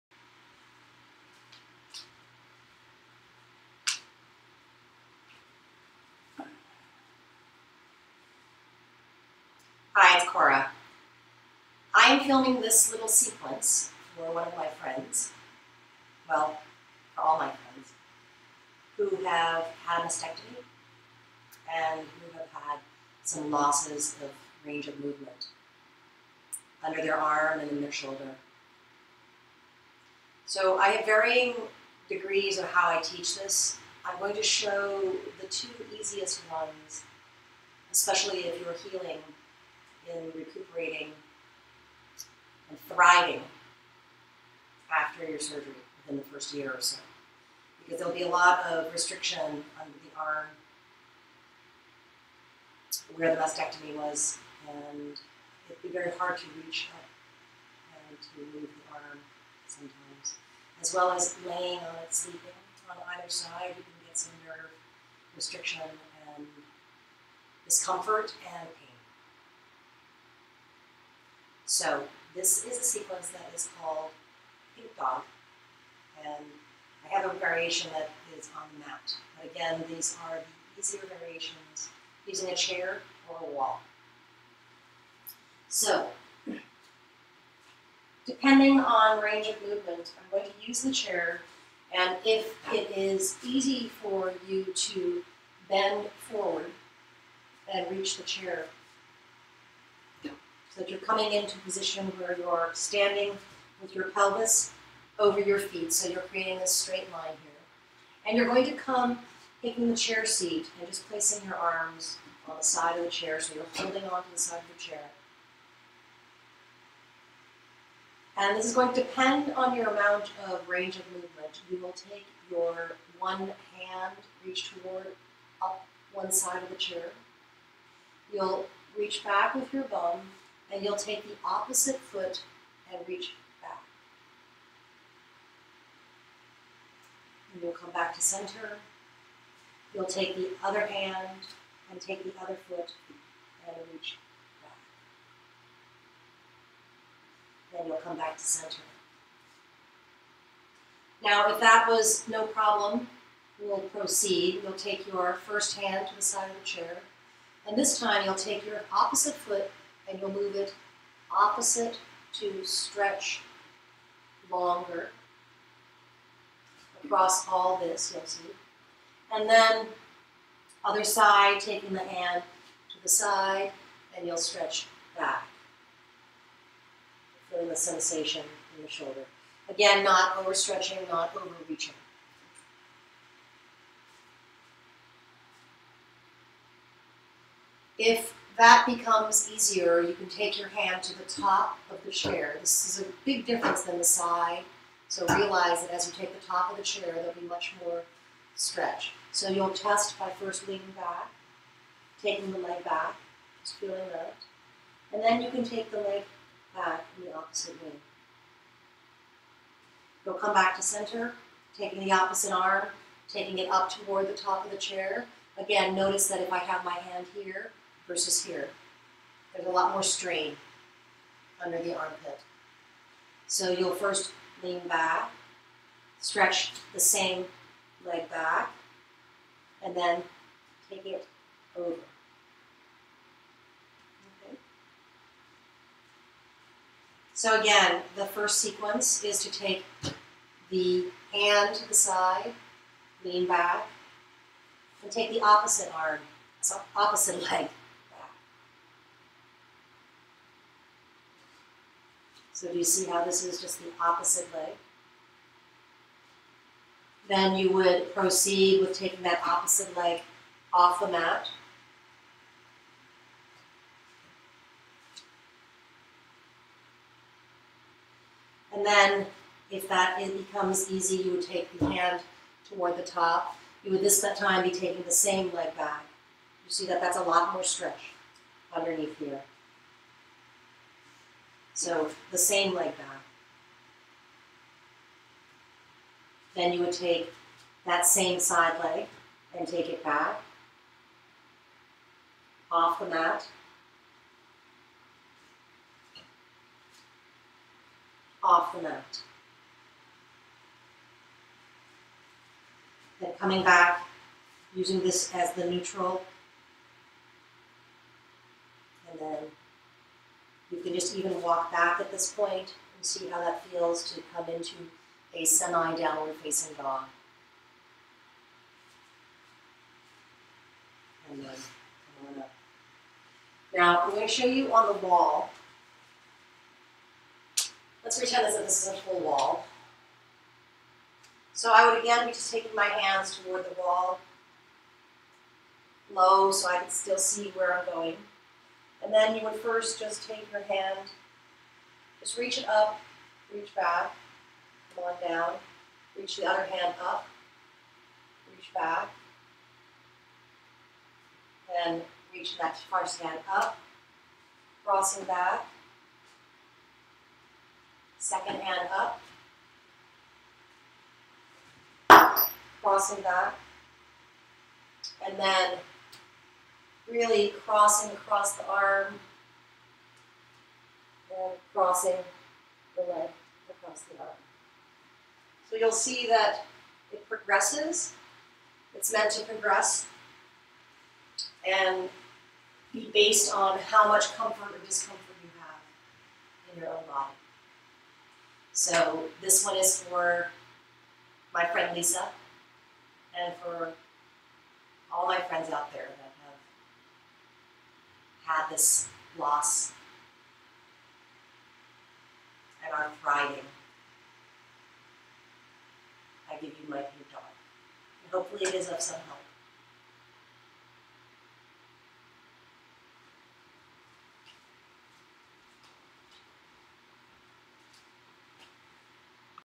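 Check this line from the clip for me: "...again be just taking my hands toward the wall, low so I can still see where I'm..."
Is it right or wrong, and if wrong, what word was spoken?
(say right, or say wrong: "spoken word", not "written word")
right.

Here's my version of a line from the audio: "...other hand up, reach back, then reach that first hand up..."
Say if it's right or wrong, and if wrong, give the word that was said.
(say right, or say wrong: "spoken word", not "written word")
right.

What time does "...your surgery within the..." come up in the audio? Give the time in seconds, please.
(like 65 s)
45 s.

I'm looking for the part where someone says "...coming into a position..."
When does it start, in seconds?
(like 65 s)
100 s.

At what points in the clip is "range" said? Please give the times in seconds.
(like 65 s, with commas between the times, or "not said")
24 s, 89 s, 120 s.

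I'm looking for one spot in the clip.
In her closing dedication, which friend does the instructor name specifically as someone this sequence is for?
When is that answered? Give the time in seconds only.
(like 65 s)
391 s.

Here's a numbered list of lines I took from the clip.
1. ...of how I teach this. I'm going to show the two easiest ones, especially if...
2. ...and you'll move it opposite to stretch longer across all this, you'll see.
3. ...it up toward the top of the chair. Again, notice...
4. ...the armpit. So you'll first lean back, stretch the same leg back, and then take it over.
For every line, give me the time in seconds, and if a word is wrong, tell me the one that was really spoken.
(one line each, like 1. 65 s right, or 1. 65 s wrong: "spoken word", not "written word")
1. 32 s right
2. 160 s right
3. 213 s right
4. 221 s right.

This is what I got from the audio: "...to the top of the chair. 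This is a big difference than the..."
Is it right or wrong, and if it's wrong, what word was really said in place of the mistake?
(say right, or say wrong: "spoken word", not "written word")
right.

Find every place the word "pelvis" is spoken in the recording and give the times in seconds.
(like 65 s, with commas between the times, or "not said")
104 s.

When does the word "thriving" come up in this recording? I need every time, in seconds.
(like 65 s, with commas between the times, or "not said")
42 s, 403 s.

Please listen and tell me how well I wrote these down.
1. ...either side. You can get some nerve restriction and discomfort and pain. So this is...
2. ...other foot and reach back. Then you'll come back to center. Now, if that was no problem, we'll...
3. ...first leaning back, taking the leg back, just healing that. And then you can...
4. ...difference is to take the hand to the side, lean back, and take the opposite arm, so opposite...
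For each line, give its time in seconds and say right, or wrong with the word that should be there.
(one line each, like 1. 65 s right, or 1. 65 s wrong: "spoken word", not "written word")
1. 63 s right
2. 142 s right
3. 200 s wrong: "feeling", not "healing"
4. 238 s wrong: "sequence", not "difference".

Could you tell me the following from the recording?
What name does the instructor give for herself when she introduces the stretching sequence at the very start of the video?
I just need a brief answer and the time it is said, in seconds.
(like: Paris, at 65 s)
Cora, at 10 s.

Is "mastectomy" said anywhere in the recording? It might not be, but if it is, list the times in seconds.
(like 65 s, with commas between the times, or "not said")
20 s, 53 s.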